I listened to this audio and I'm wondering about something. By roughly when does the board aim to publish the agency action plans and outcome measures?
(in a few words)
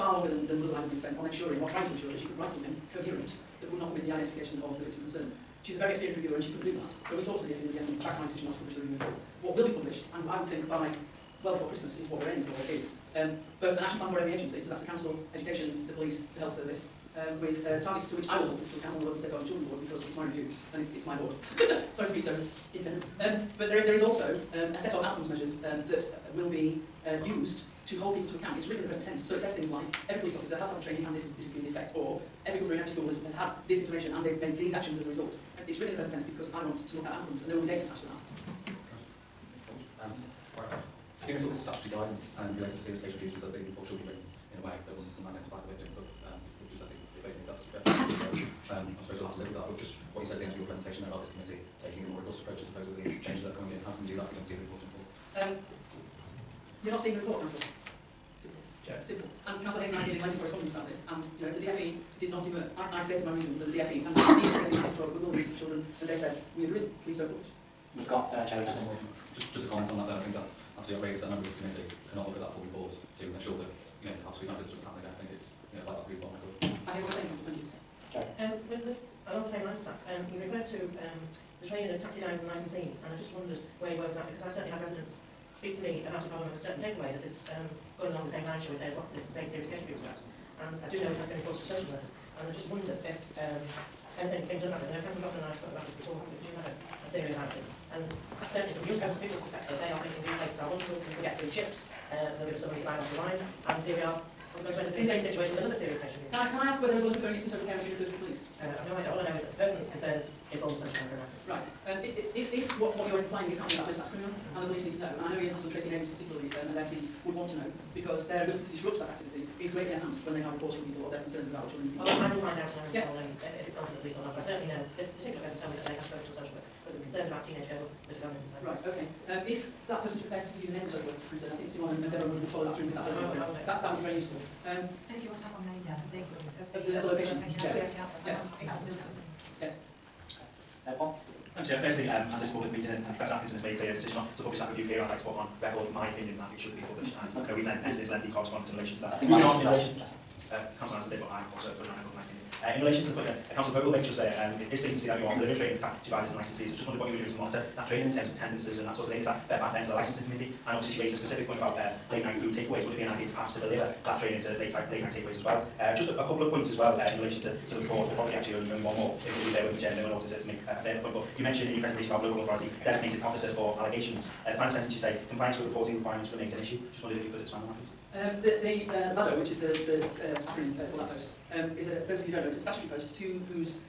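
Before Christmas.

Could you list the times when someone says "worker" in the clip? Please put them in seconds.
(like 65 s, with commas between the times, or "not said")
91 s, 110 s, 126 s, 131 s.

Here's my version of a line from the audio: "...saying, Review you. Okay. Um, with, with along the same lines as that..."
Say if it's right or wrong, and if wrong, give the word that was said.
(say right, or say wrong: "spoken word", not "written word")
wrong: "Thank", not "Review".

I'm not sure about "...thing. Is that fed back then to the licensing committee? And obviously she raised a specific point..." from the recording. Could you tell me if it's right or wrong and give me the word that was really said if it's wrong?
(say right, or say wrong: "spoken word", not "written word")
right.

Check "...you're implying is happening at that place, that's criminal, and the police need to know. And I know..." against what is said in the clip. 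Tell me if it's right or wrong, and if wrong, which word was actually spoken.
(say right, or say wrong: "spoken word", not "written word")
right.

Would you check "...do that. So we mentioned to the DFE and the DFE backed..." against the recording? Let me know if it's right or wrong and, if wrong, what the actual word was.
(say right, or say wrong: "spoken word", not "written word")
wrong: "talked", not "mentioned".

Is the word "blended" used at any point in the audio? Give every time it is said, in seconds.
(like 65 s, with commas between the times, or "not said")
not said.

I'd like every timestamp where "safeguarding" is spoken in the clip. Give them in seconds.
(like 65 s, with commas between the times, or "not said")
19 s.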